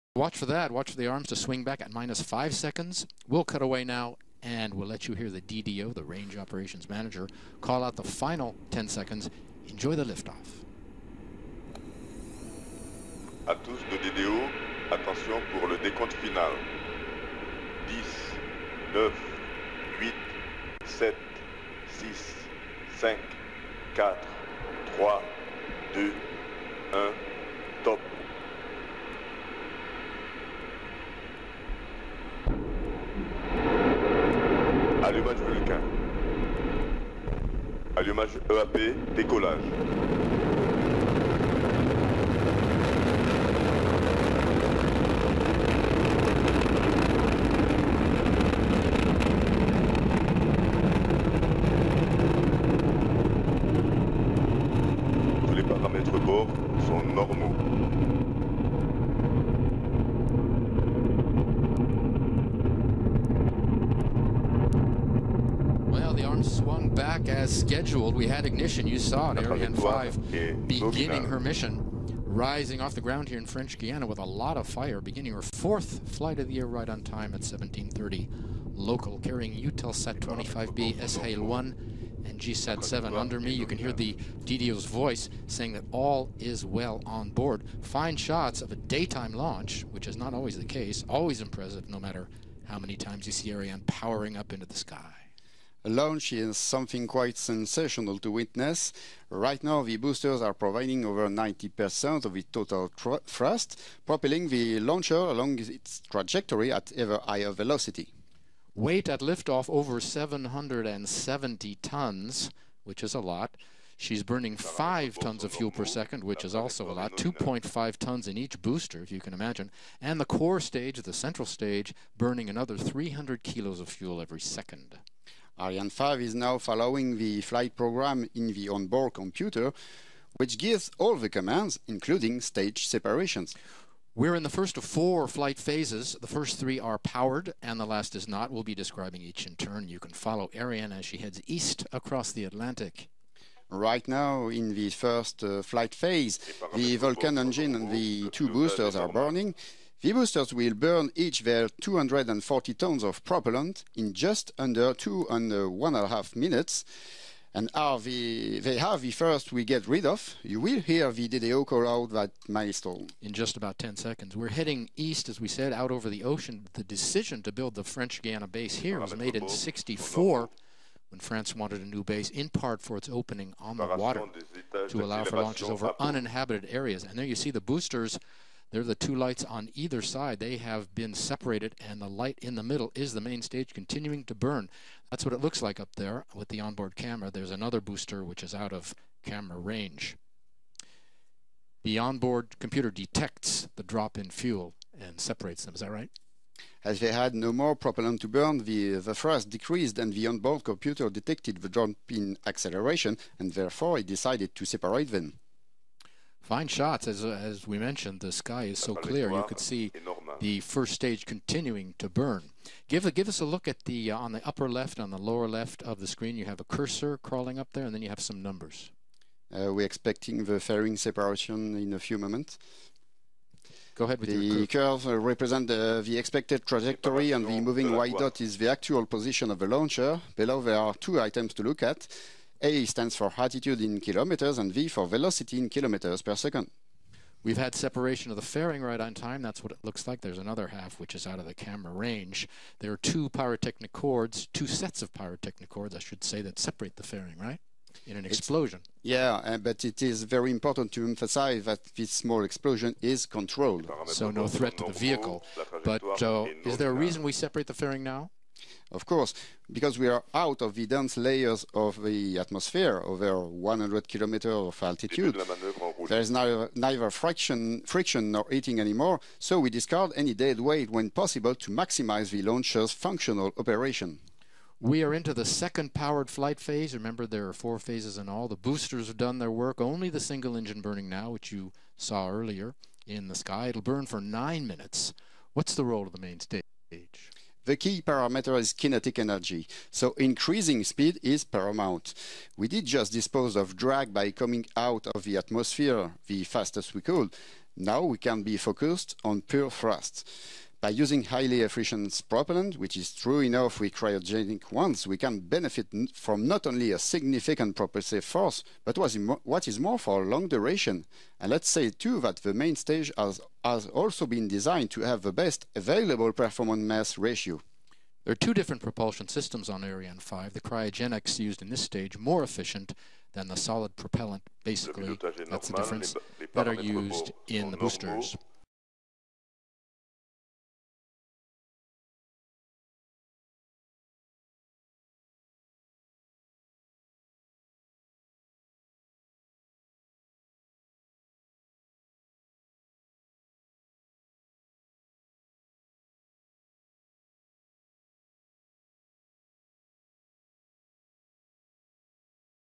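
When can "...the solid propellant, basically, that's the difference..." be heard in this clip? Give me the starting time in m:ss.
5:23.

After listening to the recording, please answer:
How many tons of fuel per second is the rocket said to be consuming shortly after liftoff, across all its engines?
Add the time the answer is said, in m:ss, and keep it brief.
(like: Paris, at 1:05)
5 tons, at 1:54.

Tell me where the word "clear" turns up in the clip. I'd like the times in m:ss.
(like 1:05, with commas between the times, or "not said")
3:28.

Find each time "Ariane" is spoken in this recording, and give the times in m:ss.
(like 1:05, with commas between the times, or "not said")
1:09, 1:33, 2:05, 2:20, 5:19.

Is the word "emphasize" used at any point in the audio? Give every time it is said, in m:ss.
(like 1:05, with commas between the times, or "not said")
4:11.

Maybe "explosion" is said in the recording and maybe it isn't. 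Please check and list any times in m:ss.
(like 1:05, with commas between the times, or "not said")
4:08, 4:12.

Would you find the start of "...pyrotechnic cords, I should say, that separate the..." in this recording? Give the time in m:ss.
4:05.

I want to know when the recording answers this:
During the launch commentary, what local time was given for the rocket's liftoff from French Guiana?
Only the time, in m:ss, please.
1:17.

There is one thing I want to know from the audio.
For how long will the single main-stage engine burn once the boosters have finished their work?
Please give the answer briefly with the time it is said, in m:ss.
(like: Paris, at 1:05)
9 minutes, at 4:44.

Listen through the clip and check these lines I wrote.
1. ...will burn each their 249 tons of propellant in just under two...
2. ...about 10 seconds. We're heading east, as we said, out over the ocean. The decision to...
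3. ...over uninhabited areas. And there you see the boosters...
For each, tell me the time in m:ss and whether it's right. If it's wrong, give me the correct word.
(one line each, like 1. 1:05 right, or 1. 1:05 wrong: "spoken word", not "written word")
1. 2:30 wrong: "240", not "249"
2. 2:43 right
3. 2:55 right.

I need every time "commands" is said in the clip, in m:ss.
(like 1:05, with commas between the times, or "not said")
2:11.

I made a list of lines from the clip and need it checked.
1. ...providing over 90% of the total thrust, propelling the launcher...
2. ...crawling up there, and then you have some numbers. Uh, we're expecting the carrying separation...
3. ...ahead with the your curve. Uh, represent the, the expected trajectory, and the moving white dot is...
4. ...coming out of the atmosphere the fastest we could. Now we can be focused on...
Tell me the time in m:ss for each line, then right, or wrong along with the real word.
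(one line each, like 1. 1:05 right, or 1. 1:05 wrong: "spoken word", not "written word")
1. 1:40 right
2. 3:37 wrong: "fairing", not "carrying"
3. 3:44 right
4. 4:54 right.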